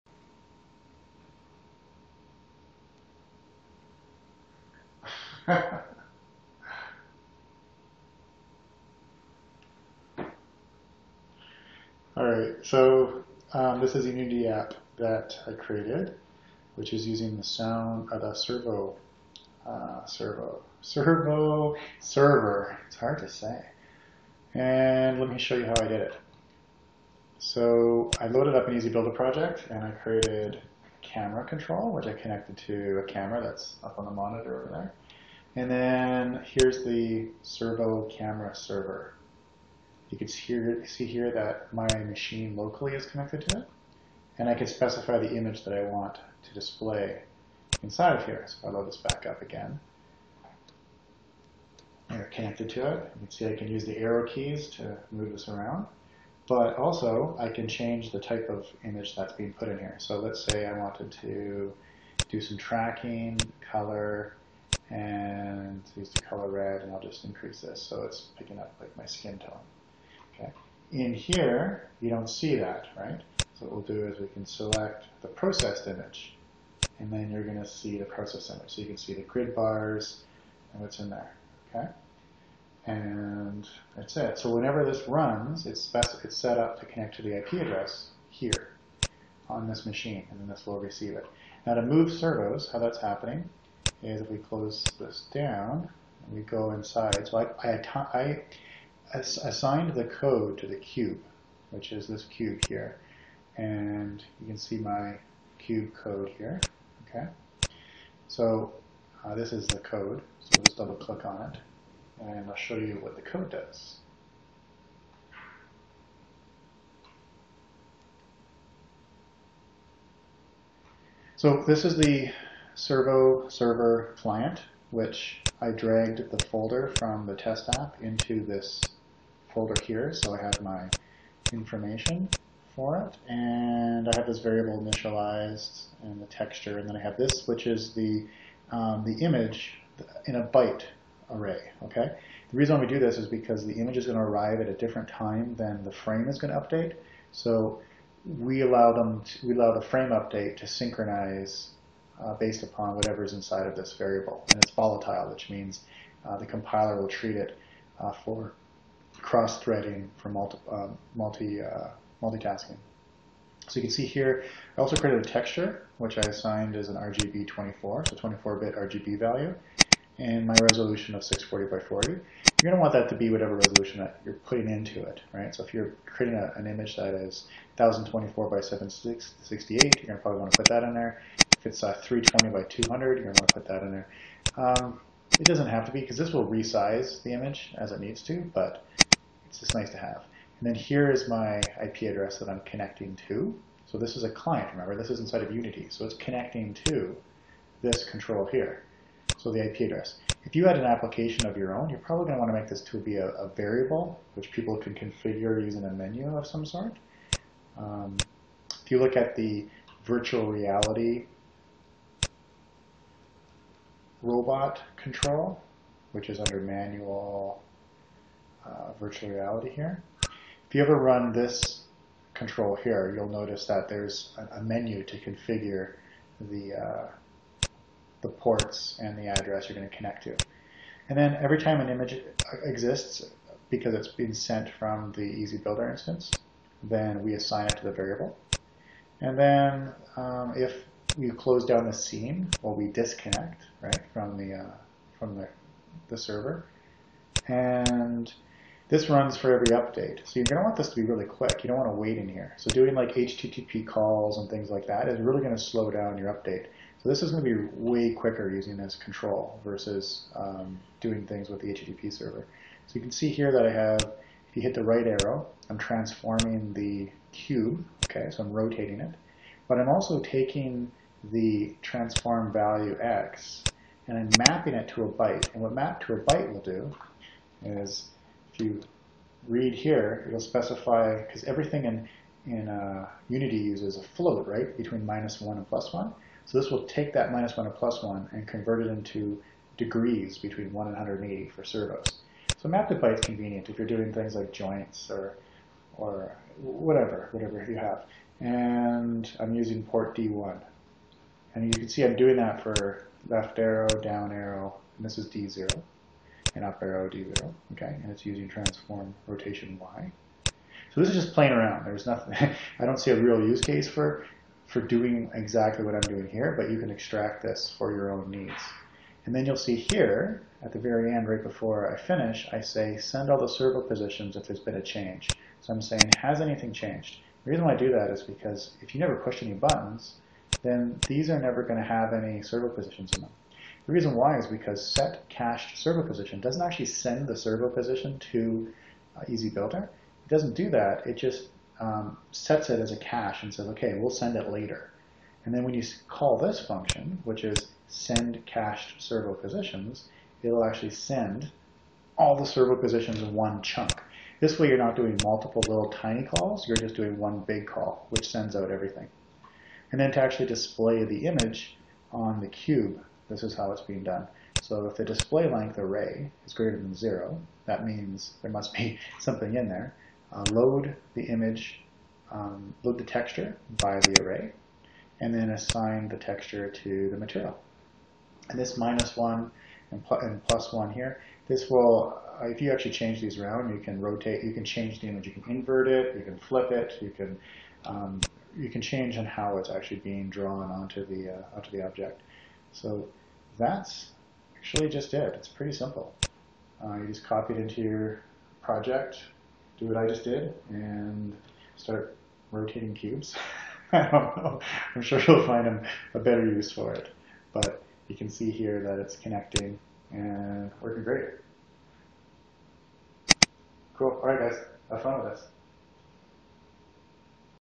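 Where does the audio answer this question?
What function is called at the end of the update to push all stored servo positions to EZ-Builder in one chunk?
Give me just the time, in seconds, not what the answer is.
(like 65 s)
347 s.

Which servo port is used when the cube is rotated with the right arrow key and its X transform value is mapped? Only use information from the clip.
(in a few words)
D1.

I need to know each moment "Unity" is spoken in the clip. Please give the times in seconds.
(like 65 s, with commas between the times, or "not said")
14 s, 195 s, 283 s.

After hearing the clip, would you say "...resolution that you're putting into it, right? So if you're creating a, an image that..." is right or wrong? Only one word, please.
right.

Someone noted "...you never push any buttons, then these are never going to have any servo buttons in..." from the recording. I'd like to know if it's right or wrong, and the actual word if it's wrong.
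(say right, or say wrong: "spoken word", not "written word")
wrong: "positions", not "buttons".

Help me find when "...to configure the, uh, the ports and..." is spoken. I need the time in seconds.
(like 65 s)
225 s.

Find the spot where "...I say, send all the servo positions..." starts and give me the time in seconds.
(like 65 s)
322 s.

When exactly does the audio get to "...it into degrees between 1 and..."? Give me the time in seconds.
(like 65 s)
288 s.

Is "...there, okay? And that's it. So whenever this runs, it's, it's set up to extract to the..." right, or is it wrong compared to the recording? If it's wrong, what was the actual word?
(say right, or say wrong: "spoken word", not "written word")
wrong: "connect", not "extract".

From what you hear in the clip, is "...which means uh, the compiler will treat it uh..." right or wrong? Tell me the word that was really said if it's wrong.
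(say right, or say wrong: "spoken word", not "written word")
right.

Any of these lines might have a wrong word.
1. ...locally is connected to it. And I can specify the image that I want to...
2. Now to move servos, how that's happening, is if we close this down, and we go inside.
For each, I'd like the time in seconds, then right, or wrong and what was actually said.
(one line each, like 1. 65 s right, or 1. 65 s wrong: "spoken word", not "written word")
1. 42 s right
2. 91 s right.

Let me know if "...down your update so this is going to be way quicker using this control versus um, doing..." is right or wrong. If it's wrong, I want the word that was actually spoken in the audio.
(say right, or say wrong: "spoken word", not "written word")
right.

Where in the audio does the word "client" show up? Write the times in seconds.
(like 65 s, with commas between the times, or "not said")
124 s, 194 s.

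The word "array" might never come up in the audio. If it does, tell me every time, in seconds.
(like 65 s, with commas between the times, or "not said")
141 s, 365 s, 374 s.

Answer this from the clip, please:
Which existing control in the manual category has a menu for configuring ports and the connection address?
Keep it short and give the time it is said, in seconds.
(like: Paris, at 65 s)
virtual reality robot control, at 210 s.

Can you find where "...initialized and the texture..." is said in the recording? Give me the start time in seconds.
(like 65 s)
134 s.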